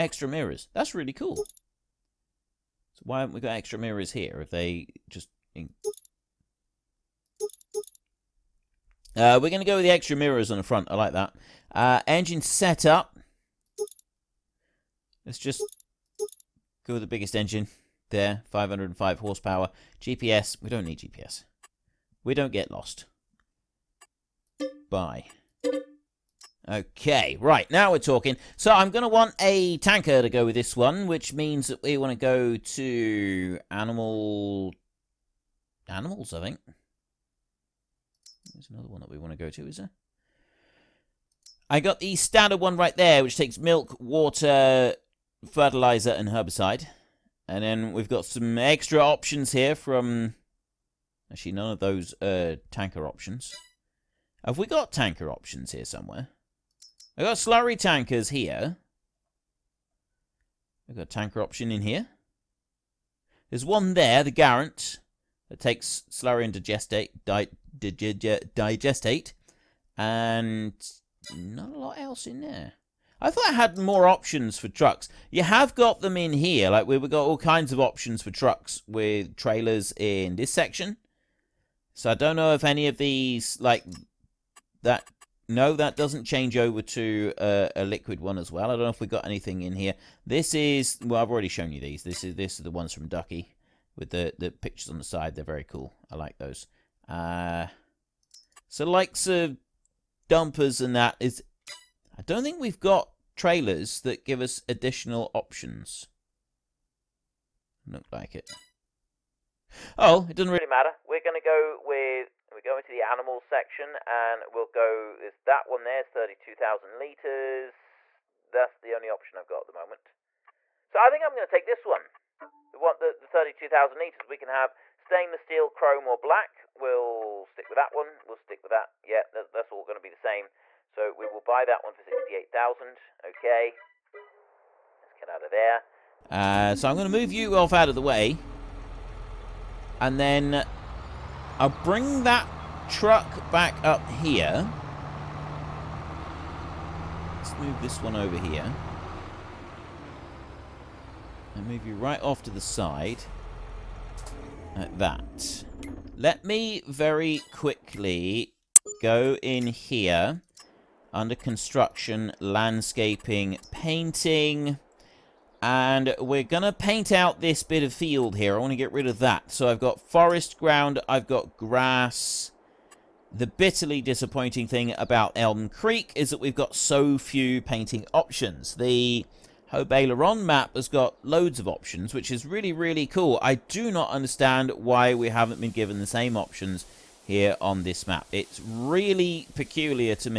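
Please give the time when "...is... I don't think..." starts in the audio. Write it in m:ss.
1:41.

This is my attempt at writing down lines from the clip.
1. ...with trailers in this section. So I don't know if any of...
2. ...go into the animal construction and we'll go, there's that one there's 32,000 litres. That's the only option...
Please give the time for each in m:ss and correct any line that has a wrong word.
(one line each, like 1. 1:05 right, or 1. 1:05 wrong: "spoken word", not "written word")
1. 1:18 right
2. 1:52 wrong: "section", not "construction".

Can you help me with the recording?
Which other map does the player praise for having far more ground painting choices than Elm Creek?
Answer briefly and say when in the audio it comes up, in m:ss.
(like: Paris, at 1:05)
Aileron, at 2:58.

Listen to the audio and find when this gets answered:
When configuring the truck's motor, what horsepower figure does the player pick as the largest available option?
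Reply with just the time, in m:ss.
0:18.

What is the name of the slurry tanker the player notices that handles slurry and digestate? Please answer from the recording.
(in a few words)
Garant.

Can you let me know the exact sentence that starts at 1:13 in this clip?
I thought I had more options for trucks.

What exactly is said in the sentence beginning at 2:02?
We want the, the 32,000 litres.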